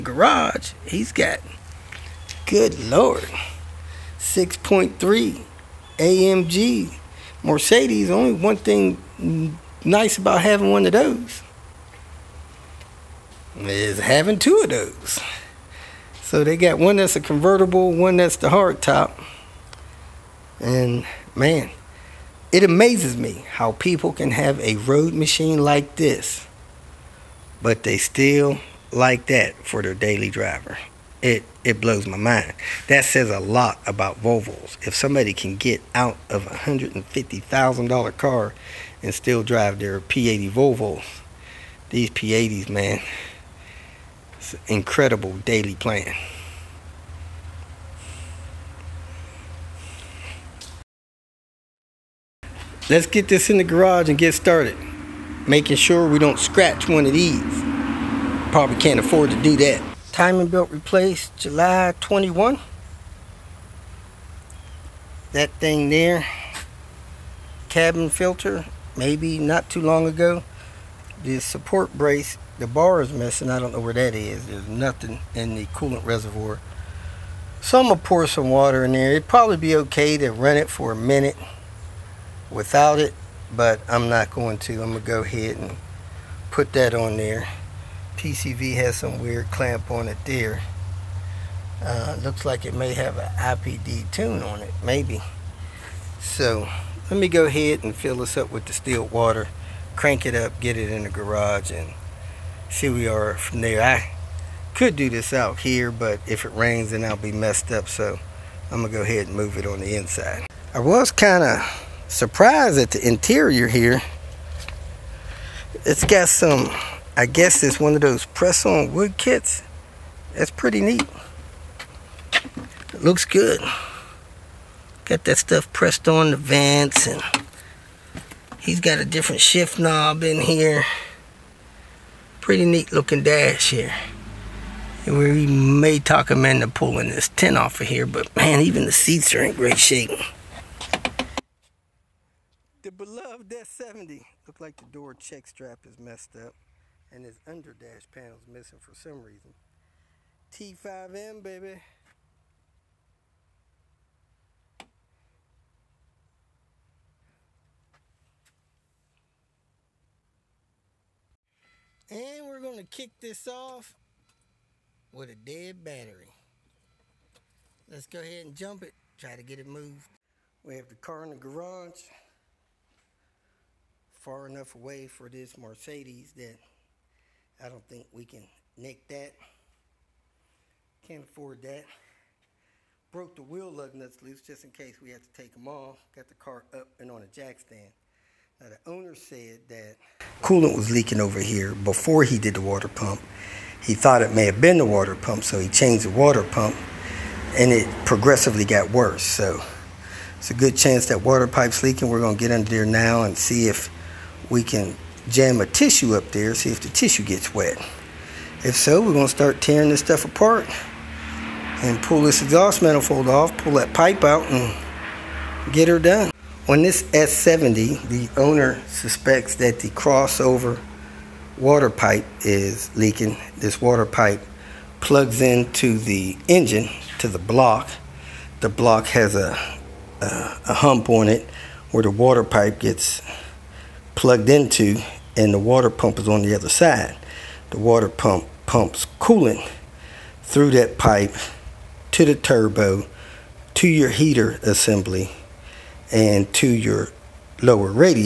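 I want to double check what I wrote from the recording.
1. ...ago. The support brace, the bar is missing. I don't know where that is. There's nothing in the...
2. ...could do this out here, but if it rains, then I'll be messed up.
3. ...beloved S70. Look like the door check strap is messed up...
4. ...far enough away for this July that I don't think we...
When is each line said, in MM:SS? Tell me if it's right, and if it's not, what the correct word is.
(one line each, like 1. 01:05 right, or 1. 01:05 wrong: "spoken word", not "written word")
1. 01:10 right
2. 01:44 right
3. 02:22 right
4. 02:54 wrong: "Mercedes", not "July".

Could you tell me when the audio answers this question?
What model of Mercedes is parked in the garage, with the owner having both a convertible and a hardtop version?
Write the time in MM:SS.
00:04.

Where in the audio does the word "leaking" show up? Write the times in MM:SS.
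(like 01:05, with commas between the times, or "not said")
03:10, 03:21, 03:42.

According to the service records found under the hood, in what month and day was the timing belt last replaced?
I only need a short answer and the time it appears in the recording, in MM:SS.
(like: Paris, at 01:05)
July 21, at 01:01.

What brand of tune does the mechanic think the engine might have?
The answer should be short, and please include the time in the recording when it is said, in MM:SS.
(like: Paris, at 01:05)
IPD, at 01:33.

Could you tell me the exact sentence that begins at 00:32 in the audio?
That says a lot about Volvos.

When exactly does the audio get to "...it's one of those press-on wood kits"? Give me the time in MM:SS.
01:57.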